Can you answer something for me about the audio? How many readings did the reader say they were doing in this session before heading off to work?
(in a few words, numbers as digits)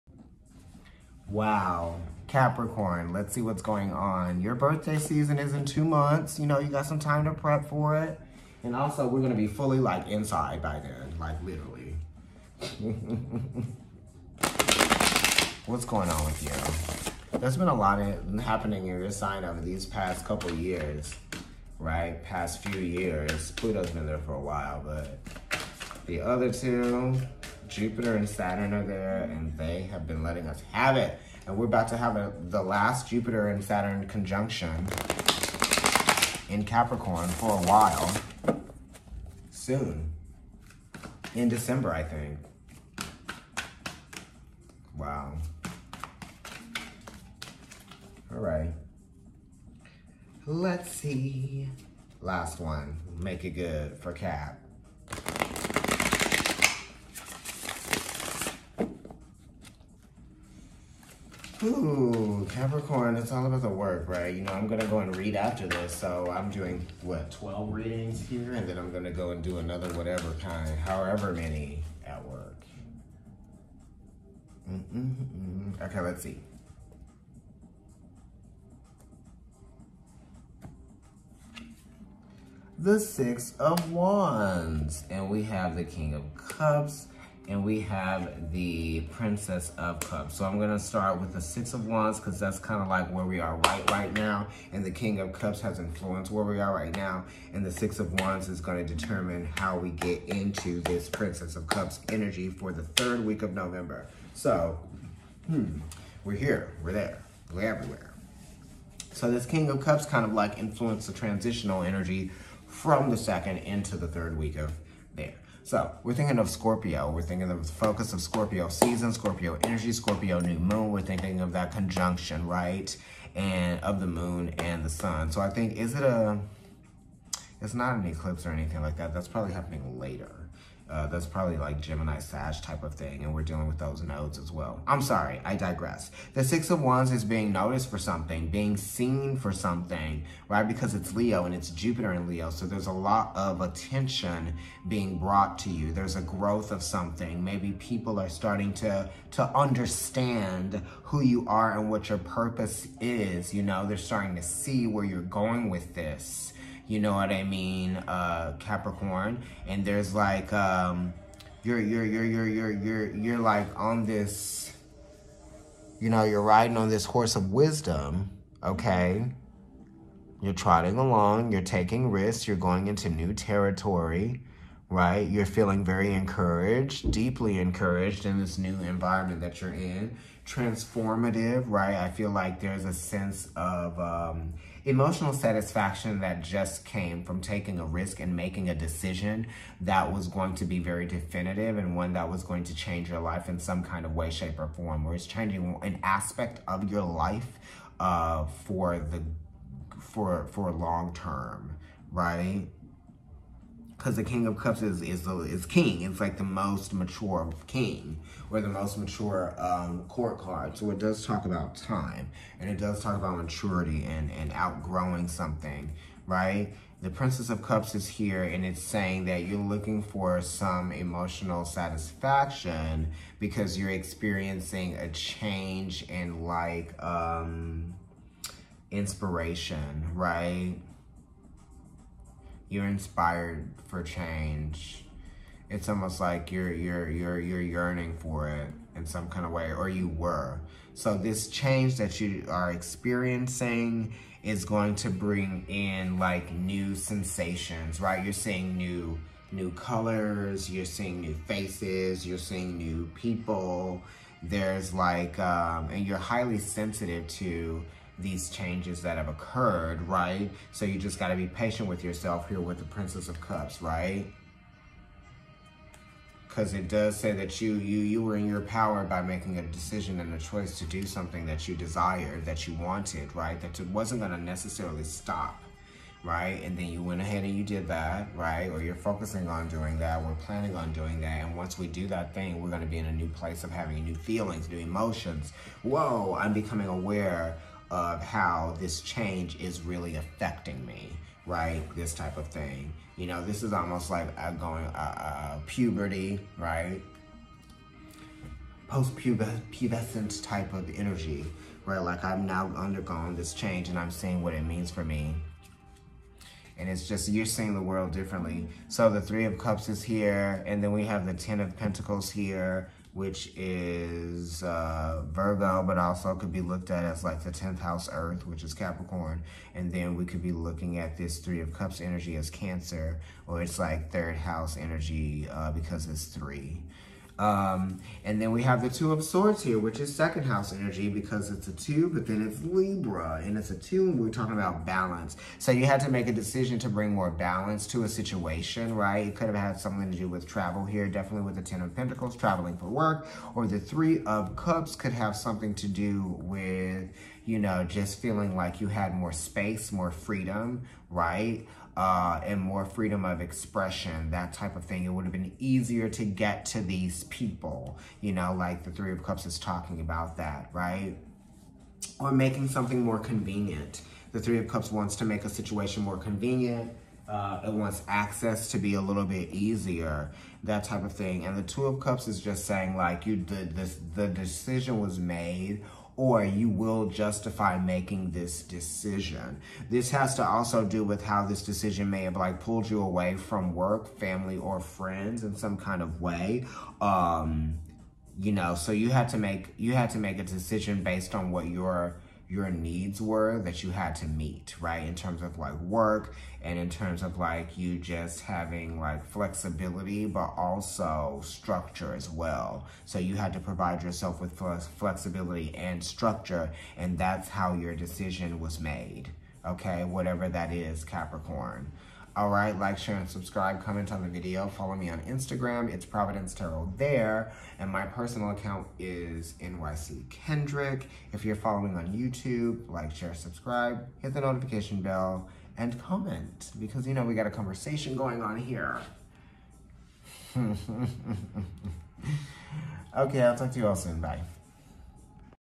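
12.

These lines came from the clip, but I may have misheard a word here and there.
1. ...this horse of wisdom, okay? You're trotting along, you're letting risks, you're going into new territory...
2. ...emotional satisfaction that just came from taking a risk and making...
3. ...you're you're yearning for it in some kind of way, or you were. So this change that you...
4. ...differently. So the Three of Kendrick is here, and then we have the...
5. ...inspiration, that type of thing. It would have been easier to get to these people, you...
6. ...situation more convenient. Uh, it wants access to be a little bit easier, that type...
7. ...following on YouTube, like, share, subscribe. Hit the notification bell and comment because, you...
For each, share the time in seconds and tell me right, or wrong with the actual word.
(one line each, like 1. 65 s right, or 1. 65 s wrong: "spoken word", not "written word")
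1. 166 s wrong: "taking", not "letting"
2. 184 s right
3. 237 s right
4. 308 s wrong: "Cups", not "Kendrick"
5. 353 s wrong: "expression", not "inspiration"
6. 365 s right
7. 421 s right.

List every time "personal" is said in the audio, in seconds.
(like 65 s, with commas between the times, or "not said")
418 s.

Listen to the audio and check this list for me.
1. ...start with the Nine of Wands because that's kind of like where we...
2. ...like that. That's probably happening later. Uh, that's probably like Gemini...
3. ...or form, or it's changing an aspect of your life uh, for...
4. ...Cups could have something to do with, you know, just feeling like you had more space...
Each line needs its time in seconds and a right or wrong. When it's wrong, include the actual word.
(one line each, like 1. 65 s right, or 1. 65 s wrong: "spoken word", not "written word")
1. 90 s wrong: "Six", not "Nine"
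2. 128 s right
3. 194 s right
4. 344 s right.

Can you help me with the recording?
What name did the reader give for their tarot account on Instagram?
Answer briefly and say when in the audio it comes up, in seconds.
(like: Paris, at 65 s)
Providence Tarot, at 416 s.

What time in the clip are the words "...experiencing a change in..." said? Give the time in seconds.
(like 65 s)
223 s.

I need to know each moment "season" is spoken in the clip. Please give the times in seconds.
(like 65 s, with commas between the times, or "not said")
4 s, 118 s.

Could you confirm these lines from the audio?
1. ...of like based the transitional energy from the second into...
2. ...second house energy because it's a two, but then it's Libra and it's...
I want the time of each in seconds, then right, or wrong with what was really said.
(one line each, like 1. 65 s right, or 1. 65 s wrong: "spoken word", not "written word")
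1. 110 s wrong: "influenced", not "based"
2. 330 s right.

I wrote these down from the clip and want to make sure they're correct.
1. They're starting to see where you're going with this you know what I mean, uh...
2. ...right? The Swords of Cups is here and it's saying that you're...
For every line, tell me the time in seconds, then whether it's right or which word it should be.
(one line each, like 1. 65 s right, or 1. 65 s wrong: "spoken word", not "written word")
1. 153 s right
2. 216 s wrong: "Princess", not "Swords".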